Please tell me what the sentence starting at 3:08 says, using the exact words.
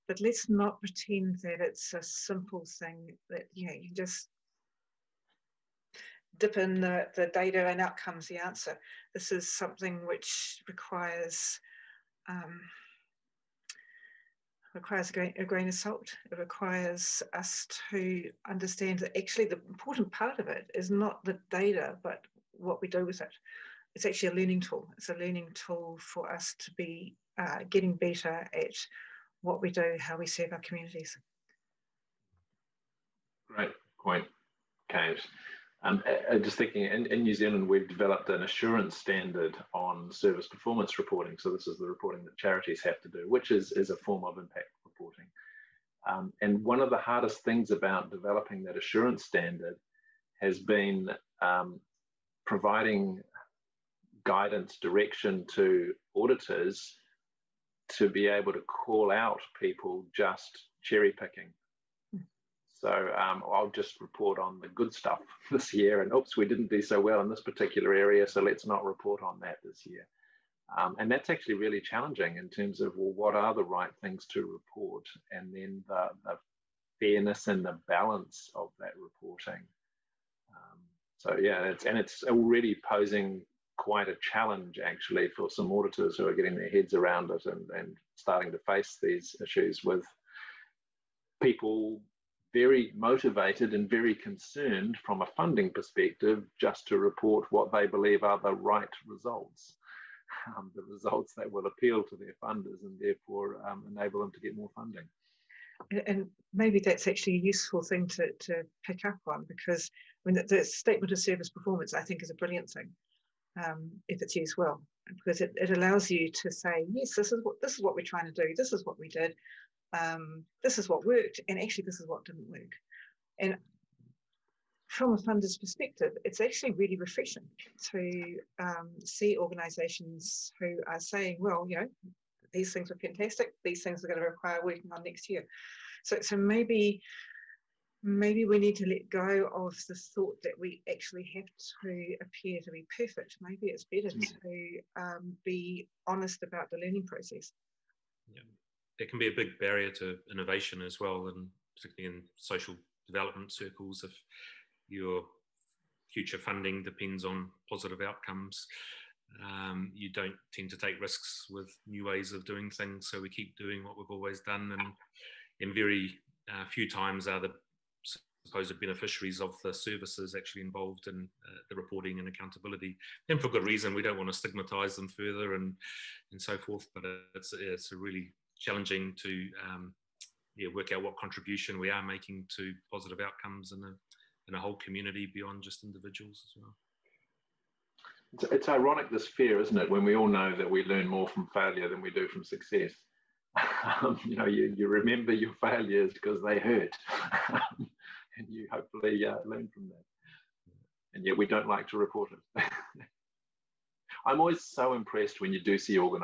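It's, it's ironic, this fear, isn't it, when we all know that we learn more from failure than we do from success.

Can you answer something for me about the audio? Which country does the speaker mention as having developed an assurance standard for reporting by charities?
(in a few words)
New Zealand.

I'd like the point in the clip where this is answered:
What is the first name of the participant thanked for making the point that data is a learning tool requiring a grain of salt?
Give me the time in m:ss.
0:34.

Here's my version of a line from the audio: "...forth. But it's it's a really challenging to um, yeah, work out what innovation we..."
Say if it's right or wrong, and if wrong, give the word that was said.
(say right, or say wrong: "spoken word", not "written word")
wrong: "contribution", not "innovation".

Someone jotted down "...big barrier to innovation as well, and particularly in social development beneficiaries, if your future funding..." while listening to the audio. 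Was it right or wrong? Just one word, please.
wrong.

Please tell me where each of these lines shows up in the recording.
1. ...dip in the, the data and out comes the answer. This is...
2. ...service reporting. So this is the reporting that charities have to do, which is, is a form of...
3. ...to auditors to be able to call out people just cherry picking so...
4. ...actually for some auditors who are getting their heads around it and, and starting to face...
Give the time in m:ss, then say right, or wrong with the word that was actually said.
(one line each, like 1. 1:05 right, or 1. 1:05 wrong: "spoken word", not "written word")
1. 0:06 right
2. 0:40 wrong: "performance", not "service"
3. 0:55 right
4. 1:24 right.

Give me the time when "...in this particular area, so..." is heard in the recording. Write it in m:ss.
1:07.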